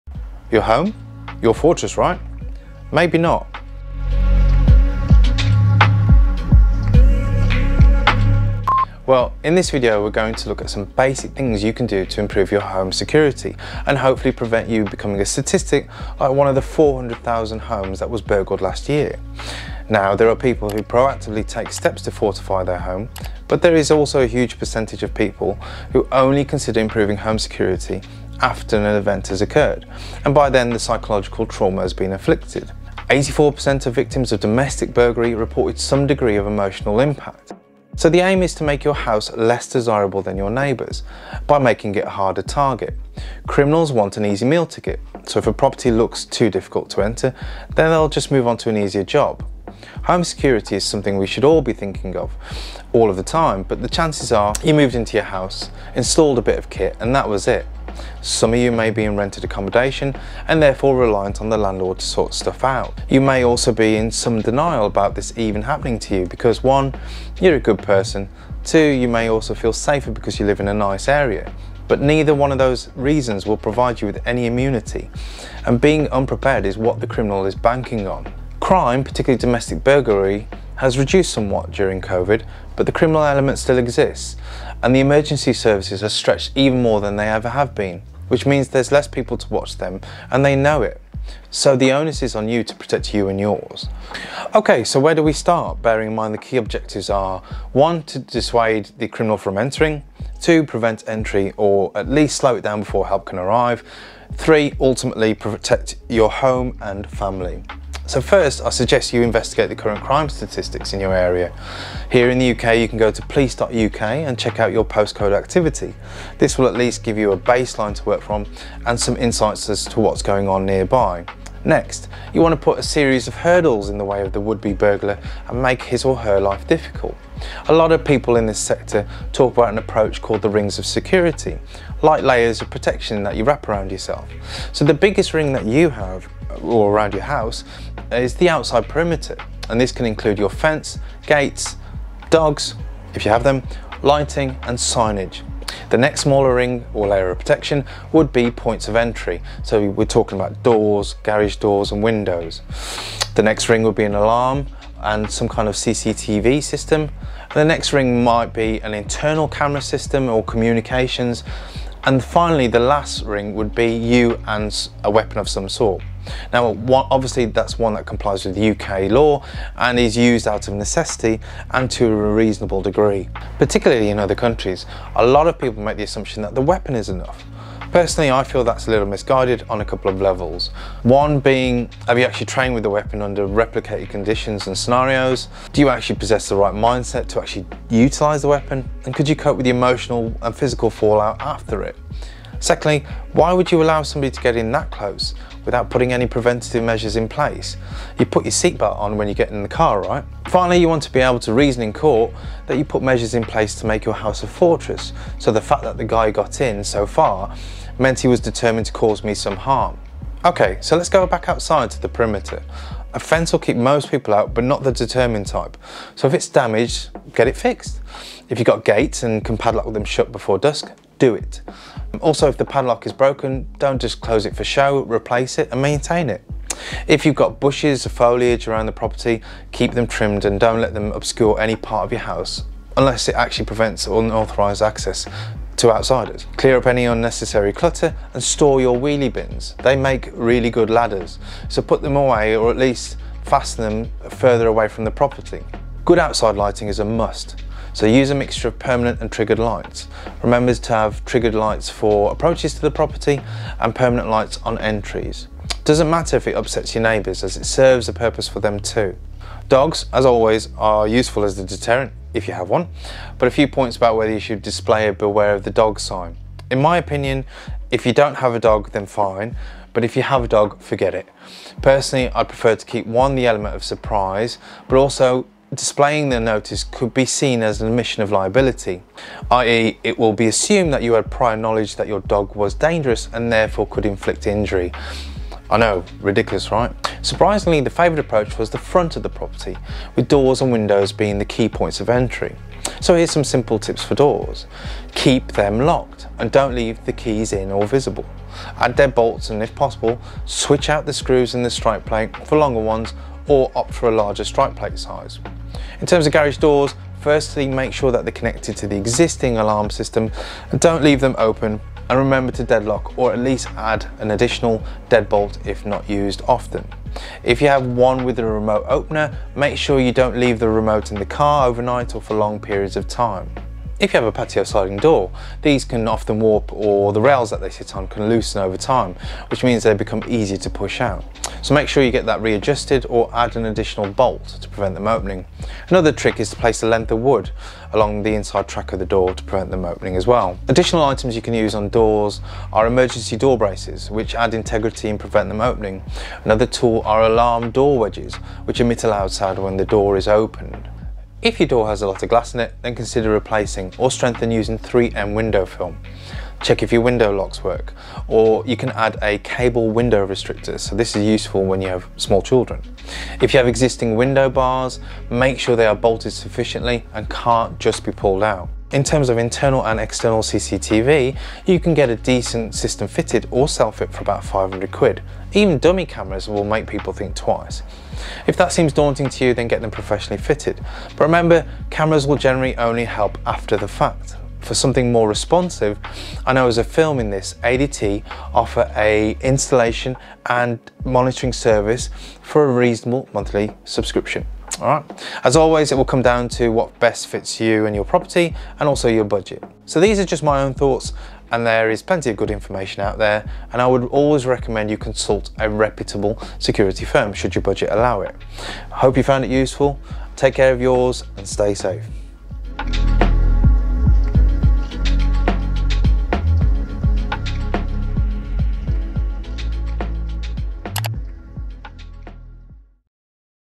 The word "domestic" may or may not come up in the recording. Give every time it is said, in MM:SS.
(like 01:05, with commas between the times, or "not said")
00:34, 01:19.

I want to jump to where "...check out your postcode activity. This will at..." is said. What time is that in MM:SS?
01:54.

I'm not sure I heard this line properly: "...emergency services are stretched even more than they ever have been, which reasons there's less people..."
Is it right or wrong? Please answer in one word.
wrong.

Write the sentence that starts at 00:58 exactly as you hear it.
Some of you may be in rented accommodation and therefore reliant on the landlord to sort stuff out.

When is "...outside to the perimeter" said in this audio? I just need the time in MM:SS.
03:31.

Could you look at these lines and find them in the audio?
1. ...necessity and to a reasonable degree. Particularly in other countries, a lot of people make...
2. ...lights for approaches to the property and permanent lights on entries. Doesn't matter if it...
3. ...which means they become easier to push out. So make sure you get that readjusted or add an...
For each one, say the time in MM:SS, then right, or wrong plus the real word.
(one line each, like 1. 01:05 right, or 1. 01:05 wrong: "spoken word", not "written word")
1. 02:50 right
2. 04:11 right
3. 05:29 right.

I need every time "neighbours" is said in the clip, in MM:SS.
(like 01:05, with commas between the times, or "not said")
00:40, 04:17.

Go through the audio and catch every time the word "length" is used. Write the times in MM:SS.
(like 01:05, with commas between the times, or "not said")
05:36.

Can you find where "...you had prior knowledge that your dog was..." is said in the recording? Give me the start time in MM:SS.
04:41.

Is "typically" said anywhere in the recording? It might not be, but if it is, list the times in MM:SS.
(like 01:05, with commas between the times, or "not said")
not said.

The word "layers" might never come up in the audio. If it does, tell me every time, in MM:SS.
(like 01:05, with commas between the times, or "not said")
02:12, 02:27.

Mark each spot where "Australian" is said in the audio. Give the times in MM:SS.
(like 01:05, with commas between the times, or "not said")
not said.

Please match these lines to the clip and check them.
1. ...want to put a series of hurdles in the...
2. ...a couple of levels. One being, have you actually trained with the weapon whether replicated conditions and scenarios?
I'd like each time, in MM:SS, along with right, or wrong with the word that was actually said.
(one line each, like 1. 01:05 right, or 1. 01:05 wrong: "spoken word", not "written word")
1. 02:02 right
2. 02:59 wrong: "under", not "whether".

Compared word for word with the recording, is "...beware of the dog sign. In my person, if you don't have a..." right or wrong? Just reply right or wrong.
wrong.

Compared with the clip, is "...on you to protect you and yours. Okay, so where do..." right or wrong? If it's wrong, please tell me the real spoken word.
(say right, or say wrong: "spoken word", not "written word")
right.